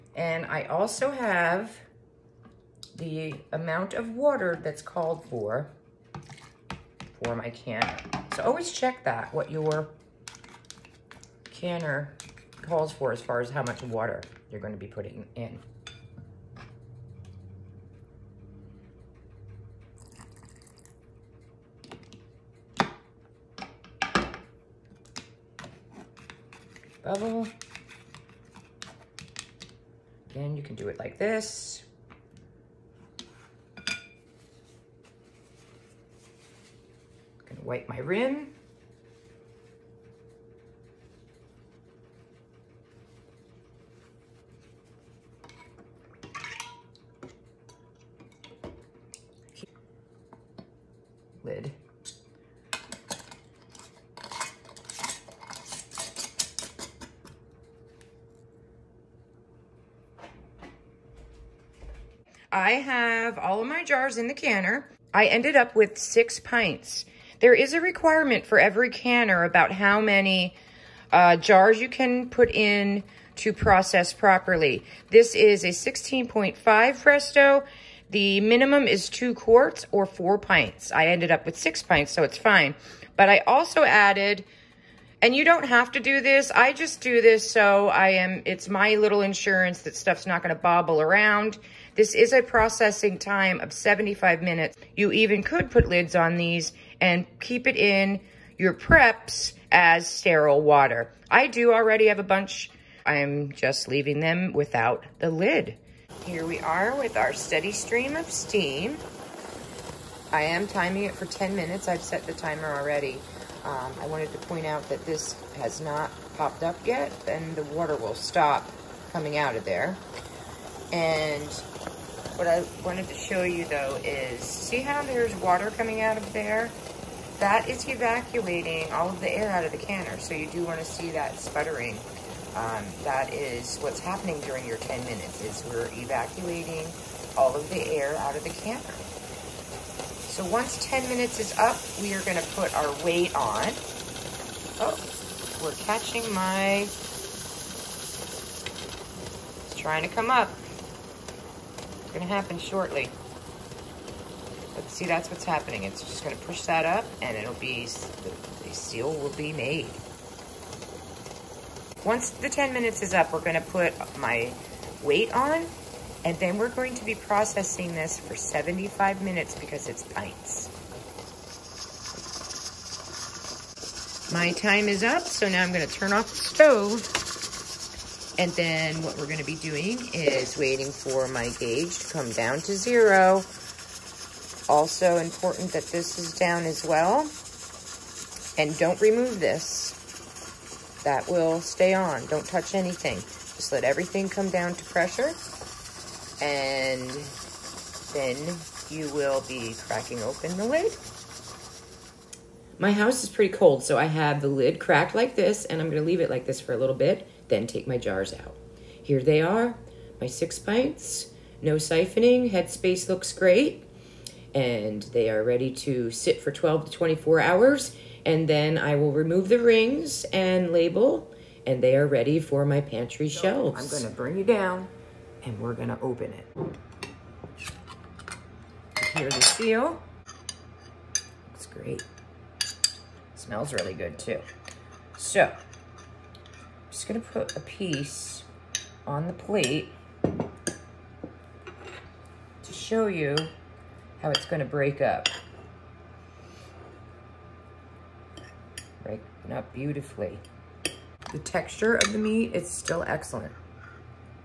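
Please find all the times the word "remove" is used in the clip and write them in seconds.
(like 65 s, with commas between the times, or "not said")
189 s, 219 s.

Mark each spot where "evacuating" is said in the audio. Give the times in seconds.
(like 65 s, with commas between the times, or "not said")
127 s, 135 s.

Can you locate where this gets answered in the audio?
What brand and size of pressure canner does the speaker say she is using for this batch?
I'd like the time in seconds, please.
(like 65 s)
75 s.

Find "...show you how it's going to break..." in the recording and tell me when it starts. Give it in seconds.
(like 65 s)
242 s.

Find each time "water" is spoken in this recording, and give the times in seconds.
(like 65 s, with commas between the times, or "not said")
4 s, 13 s, 100 s, 117 s, 125 s.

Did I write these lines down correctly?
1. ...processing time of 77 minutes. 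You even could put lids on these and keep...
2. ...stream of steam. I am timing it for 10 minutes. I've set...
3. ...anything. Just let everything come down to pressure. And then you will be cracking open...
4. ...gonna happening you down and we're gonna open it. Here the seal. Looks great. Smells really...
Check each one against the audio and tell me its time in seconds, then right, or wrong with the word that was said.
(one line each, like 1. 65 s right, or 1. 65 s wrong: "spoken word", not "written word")
1. 92 s wrong: "75", not "77"
2. 107 s right
3. 192 s right
4. 224 s wrong: "bring", not "happening".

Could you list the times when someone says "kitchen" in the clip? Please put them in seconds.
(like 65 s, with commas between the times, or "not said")
not said.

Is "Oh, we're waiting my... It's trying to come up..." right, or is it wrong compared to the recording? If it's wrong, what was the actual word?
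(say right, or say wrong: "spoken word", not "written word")
wrong: "catching", not "waiting".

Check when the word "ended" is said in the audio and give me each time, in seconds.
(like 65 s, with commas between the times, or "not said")
65 s, 81 s.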